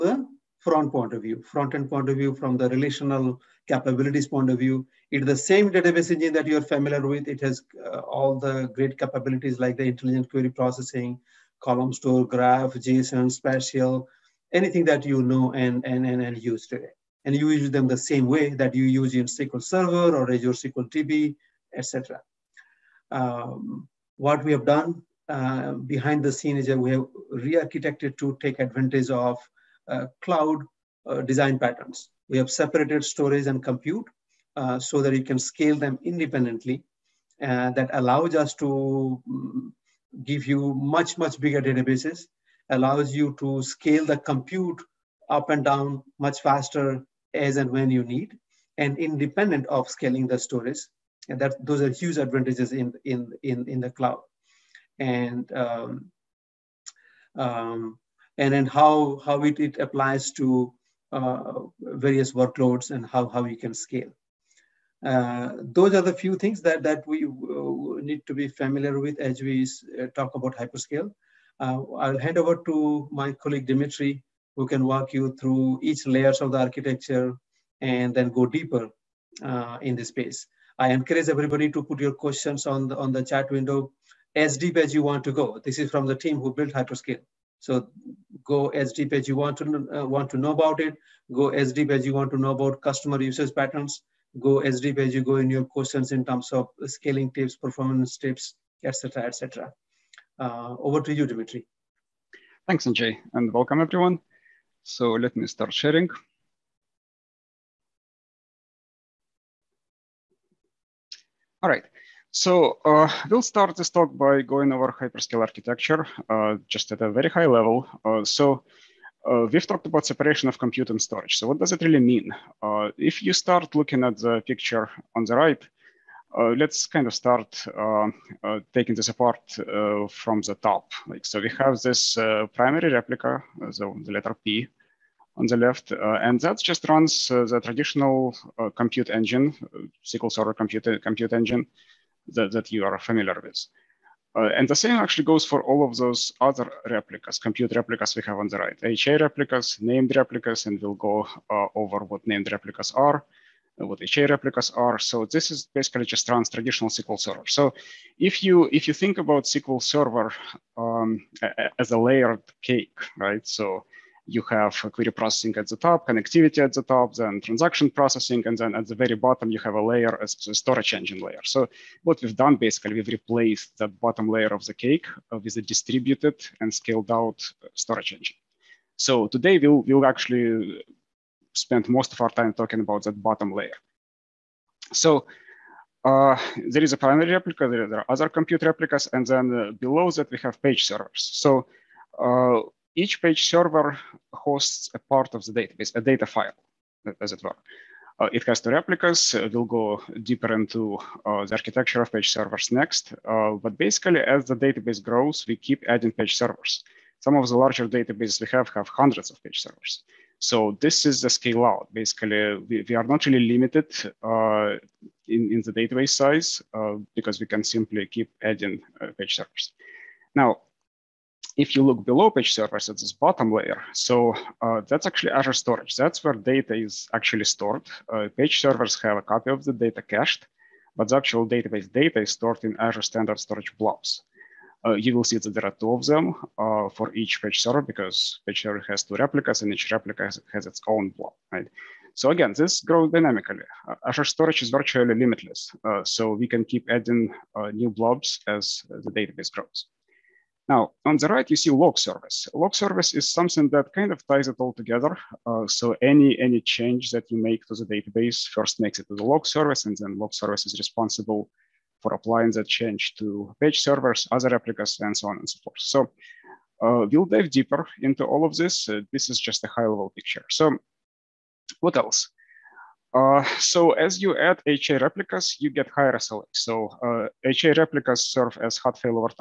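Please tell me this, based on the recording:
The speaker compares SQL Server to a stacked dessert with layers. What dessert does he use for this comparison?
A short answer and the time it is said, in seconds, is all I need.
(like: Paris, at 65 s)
Layered cake, at 161 s.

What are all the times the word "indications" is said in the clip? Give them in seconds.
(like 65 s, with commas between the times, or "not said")
not said.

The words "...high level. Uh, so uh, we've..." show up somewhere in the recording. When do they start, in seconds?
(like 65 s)
117 s.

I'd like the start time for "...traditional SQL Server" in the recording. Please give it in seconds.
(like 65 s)
156 s.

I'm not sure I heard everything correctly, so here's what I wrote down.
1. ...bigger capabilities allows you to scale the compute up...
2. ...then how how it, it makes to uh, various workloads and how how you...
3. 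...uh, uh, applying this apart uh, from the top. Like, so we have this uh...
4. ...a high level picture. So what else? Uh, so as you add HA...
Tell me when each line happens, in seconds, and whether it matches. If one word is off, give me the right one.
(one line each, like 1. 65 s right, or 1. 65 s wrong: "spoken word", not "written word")
1. 41 s wrong: "databases", not "capabilities"
2. 58 s wrong: "applies", not "makes"
3. 127 s wrong: "taking", not "applying"
4. 269 s right.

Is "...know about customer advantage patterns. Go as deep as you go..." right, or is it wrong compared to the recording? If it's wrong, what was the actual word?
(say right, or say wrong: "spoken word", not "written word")
wrong: "usage", not "advantage".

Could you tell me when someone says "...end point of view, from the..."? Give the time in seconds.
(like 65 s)
1 s.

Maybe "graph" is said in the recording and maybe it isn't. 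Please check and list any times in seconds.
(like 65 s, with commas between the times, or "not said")
12 s.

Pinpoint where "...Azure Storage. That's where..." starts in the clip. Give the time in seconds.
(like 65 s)
225 s.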